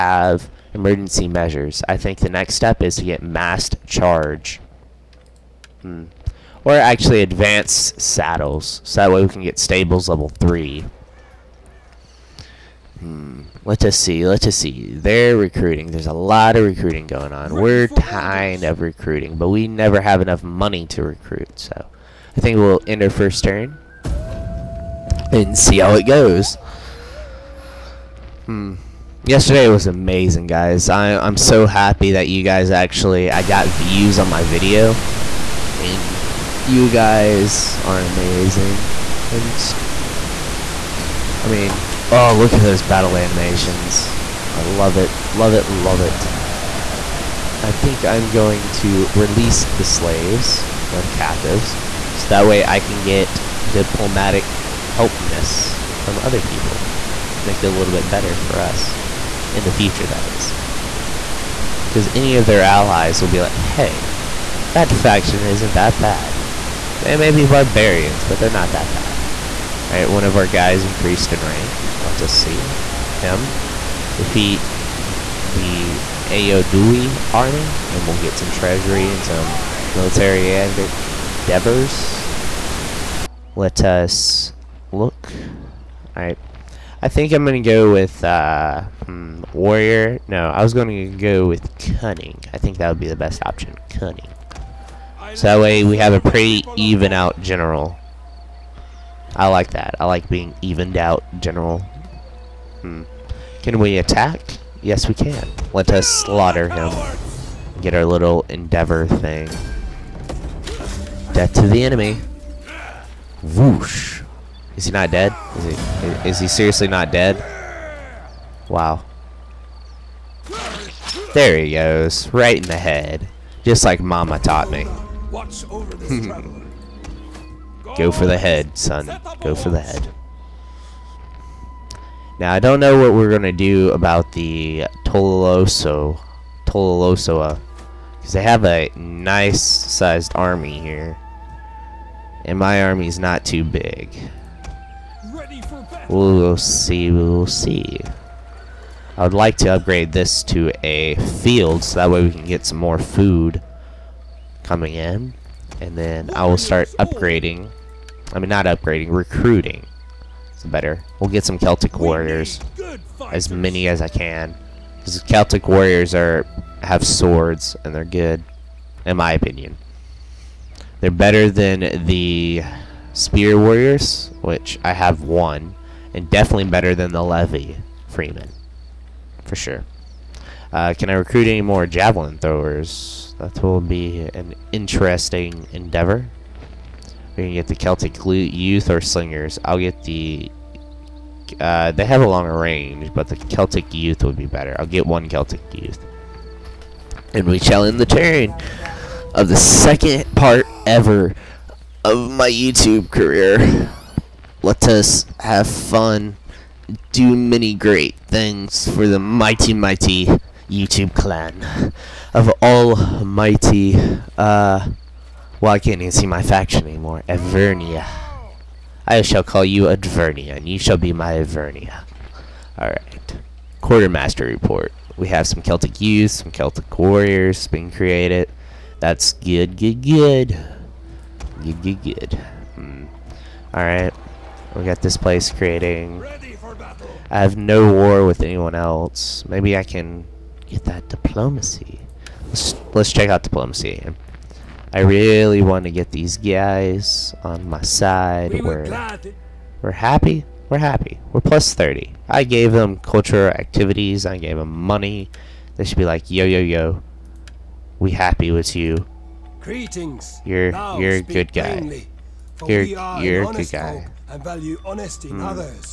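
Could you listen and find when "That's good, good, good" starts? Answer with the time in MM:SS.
03:48.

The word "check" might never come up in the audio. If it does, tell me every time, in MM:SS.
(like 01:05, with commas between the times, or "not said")
04:03.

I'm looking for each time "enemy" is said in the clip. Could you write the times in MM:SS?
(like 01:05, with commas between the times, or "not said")
01:51.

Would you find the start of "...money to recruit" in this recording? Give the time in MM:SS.
00:20.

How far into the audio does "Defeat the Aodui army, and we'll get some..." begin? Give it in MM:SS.
01:14.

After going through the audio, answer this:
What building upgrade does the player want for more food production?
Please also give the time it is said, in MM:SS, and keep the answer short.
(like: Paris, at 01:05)
Field, at 02:31.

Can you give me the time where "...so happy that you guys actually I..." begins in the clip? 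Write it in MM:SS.
00:31.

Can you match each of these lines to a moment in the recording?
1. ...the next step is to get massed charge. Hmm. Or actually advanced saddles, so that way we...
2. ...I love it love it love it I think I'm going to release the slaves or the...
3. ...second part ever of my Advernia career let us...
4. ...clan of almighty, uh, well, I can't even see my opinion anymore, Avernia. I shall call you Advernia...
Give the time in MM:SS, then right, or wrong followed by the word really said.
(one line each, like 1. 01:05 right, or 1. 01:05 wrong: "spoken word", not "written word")
1. 00:02 right
2. 00:44 right
3. 03:19 wrong: "YouTube", not "Advernia"
4. 03:31 wrong: "faction", not "opinion".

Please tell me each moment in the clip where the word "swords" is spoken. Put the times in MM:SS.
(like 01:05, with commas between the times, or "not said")
02:47.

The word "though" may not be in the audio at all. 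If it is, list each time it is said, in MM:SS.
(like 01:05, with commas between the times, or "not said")
not said.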